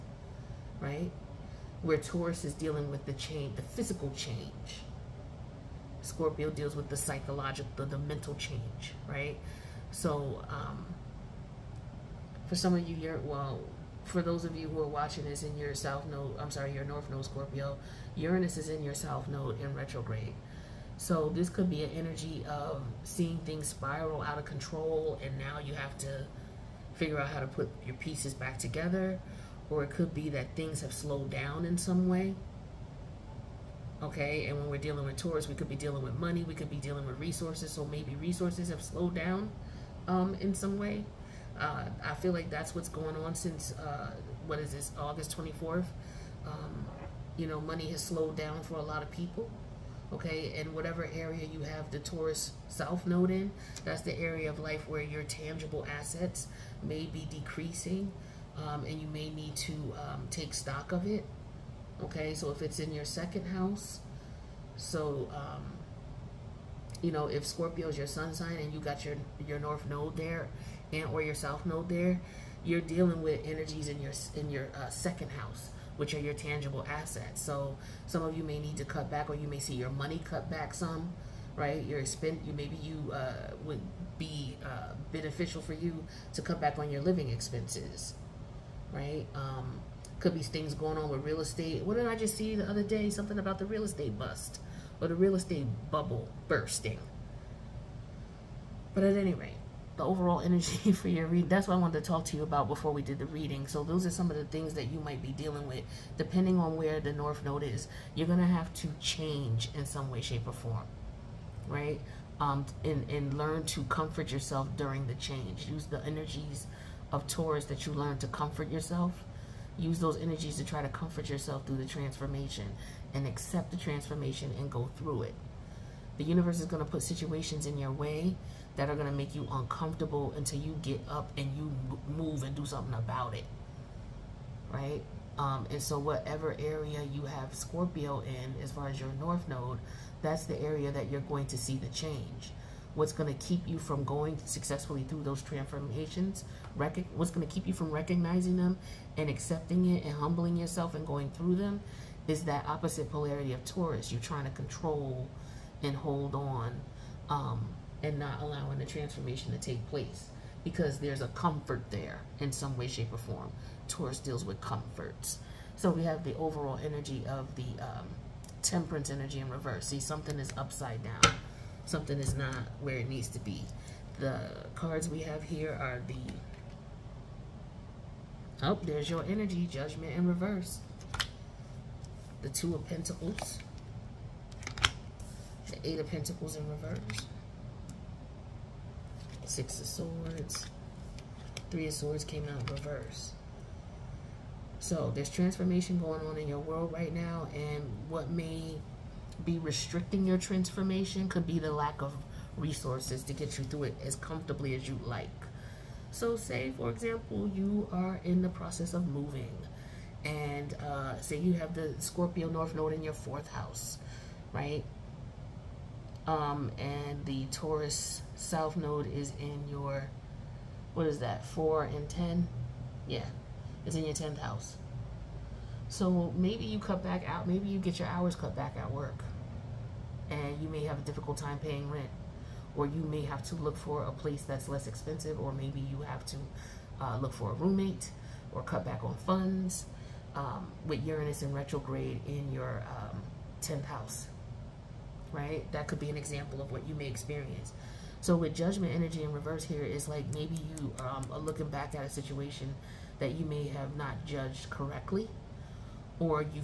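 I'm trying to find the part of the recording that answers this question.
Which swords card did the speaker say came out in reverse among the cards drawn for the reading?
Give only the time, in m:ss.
3:11.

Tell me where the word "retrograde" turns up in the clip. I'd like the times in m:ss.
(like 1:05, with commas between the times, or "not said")
0:19, 4:01.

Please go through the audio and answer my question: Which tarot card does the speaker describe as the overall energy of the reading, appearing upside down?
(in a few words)
Temperance.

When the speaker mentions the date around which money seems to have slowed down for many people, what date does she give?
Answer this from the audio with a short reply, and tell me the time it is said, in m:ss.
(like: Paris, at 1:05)
August 24th, at 0:44.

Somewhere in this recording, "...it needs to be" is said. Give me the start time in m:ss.
2:52.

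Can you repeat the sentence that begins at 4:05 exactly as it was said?
That could be an example of what you may experience.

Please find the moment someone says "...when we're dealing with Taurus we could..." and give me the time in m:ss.
0:34.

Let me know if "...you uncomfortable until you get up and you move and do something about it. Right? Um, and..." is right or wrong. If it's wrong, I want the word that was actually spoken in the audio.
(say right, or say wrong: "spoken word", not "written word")
right.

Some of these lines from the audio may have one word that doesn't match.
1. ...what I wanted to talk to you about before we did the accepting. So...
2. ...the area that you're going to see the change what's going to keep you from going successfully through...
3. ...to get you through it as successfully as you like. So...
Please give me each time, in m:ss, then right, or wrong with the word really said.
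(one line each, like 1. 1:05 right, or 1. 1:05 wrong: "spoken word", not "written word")
1. 1:41 wrong: "reading", not "accepting"
2. 2:20 right
3. 3:23 wrong: "comfortably", not "successfully".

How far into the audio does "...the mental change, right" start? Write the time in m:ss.
0:07.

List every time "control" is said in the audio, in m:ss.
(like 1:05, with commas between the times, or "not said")
0:24, 2:34.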